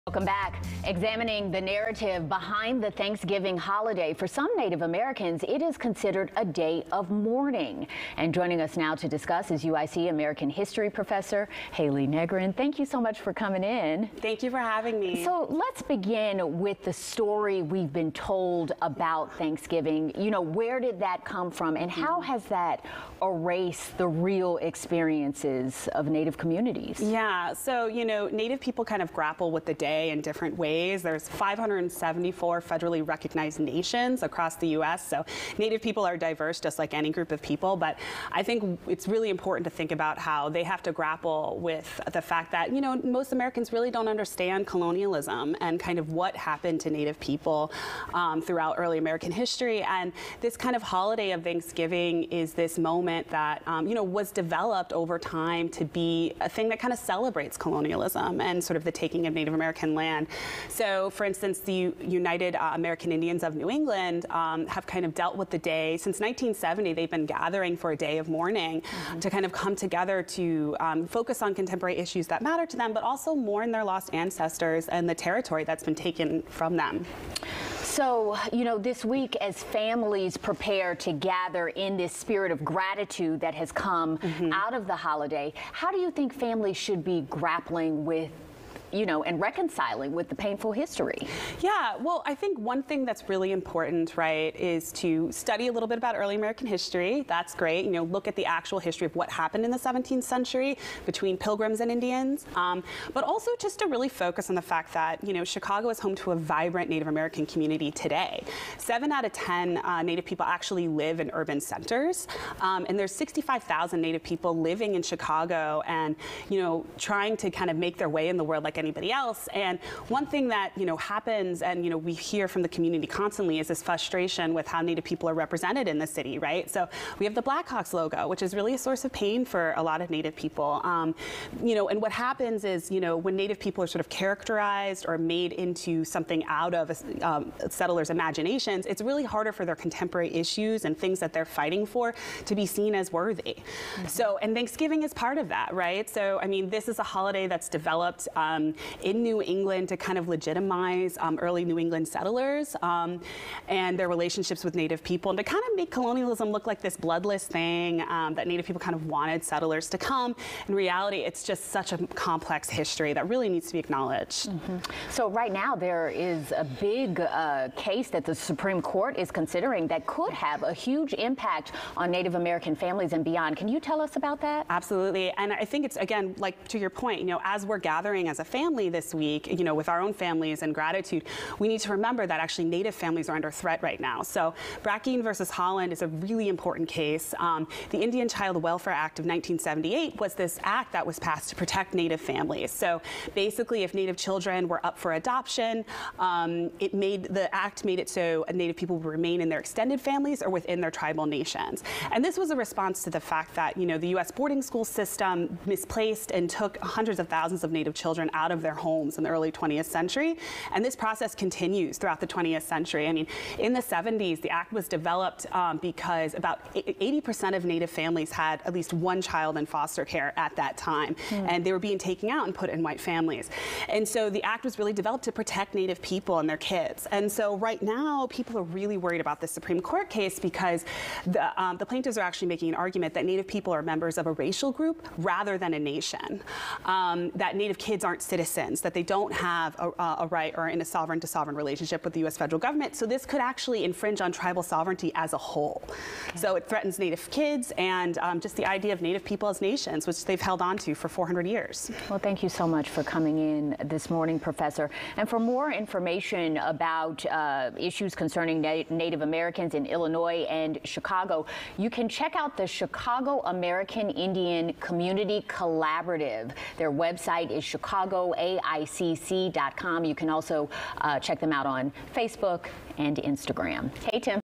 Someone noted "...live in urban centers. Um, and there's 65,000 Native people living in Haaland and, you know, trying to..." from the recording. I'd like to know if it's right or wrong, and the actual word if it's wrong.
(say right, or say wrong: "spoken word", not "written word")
wrong: "Chicago", not "Haaland".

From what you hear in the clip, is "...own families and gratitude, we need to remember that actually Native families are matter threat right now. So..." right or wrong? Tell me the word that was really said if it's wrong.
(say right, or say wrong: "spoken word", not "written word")
wrong: "under", not "matter".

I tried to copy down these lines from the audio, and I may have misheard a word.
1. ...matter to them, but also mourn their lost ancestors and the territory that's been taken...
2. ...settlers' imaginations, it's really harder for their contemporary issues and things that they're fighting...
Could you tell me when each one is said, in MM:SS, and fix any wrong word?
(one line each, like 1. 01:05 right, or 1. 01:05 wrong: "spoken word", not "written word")
1. 01:12 right
2. 02:17 right.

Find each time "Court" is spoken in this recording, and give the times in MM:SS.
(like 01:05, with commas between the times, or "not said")
02:48, 03:49.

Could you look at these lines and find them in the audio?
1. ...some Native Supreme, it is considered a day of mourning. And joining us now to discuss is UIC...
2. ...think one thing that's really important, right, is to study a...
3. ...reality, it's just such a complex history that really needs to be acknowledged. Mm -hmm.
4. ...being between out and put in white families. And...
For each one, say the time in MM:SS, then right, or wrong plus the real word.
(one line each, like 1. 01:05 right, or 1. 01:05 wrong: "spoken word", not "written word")
1. 00:04 wrong: "Americans", not "Supreme"
2. 01:32 right
3. 02:40 right
4. 03:41 wrong: "taken", not "between".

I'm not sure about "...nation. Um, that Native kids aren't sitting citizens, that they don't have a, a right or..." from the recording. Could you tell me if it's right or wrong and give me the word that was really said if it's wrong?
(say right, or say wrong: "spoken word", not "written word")
right.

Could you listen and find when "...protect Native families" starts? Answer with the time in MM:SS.
03:11.